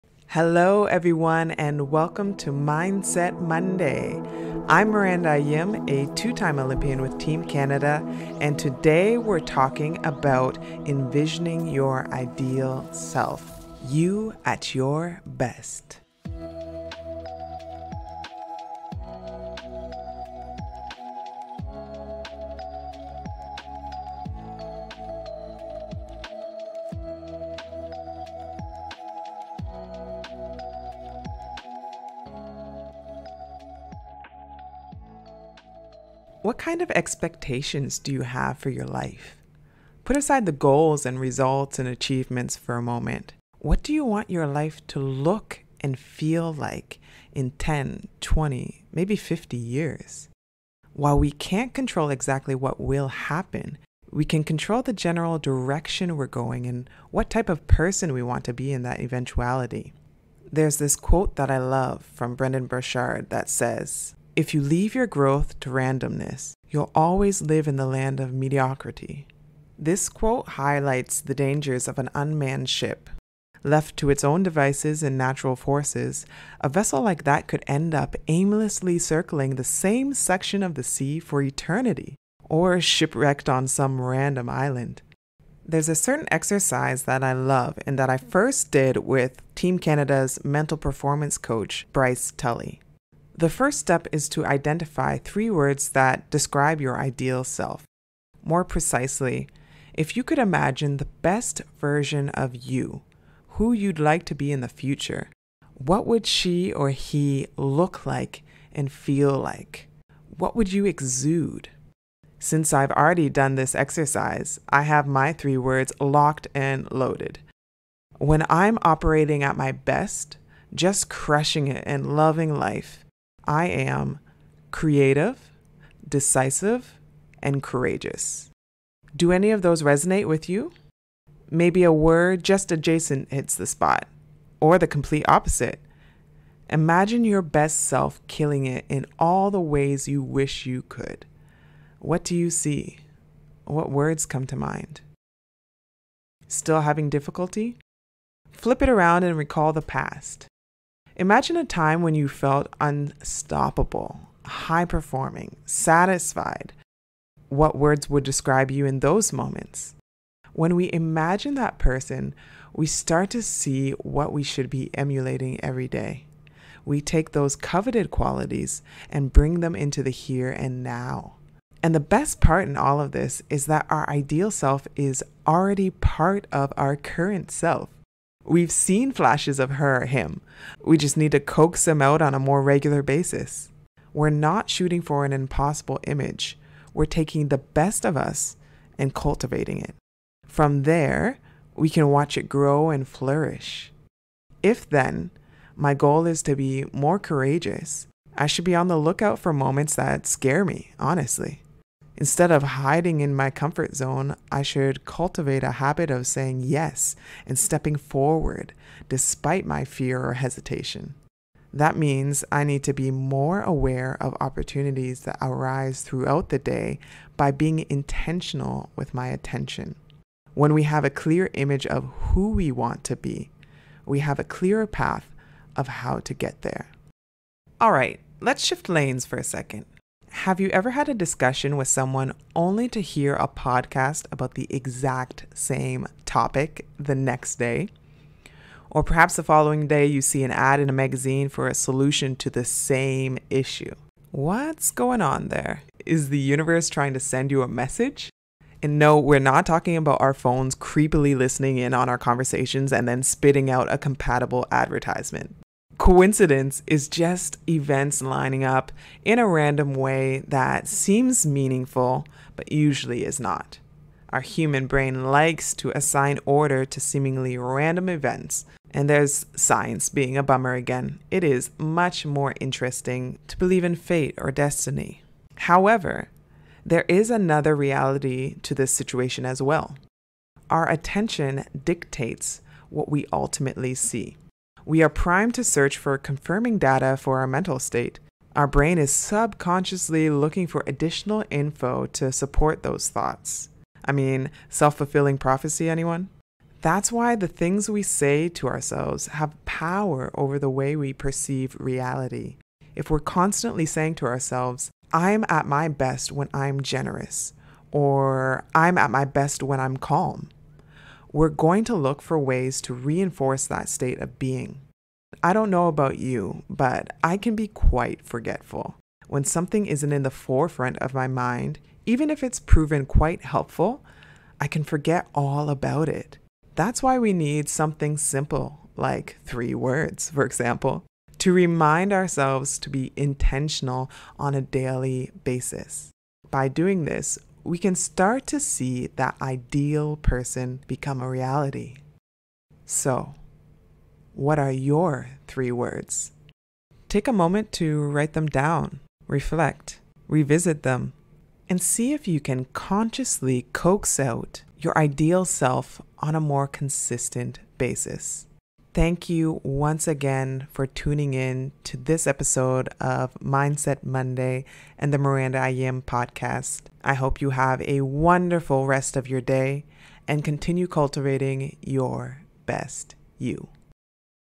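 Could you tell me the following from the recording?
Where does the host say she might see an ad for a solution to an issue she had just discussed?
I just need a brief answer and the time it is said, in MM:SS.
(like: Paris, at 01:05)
a magazine, at 04:00.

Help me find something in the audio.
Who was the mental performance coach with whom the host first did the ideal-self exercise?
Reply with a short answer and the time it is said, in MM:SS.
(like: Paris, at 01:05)
Bryce Tully, at 01:31.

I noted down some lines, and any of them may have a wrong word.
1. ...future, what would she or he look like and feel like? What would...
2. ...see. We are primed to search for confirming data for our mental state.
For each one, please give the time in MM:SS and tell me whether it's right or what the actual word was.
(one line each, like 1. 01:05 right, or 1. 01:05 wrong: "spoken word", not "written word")
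1. 01:44 right
2. 04:43 right.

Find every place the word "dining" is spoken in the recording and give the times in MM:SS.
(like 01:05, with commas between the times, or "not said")
not said.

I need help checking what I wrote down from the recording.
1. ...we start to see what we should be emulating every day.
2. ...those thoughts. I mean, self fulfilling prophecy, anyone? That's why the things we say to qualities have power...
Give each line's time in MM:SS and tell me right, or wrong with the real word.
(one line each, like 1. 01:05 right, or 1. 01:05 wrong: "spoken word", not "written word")
1. 02:42 right
2. 04:52 wrong: "ourselves", not "qualities".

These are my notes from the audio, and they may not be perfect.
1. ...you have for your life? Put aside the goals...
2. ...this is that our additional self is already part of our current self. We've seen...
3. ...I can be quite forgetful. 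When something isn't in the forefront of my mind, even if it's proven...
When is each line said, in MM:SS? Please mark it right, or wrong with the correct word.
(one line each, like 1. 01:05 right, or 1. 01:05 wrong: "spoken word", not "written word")
1. 00:38 right
2. 02:53 wrong: "ideal", not "additional"
3. 05:17 right.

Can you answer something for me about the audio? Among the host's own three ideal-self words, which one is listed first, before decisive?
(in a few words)
creative.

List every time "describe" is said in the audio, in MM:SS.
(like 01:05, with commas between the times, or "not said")
01:36, 02:38.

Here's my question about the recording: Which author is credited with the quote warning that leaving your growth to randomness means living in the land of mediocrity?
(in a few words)
Brendon Burchard.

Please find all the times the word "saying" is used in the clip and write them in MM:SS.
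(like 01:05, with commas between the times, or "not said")
03:26, 05:03.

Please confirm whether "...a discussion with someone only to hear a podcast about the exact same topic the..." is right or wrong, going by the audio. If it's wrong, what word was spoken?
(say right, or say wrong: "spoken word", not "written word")
right.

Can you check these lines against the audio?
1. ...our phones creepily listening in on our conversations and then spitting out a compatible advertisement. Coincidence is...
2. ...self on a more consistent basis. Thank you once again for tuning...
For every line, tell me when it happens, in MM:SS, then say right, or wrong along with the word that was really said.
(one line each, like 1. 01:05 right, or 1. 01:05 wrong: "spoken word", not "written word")
1. 04:10 right
2. 05:55 right.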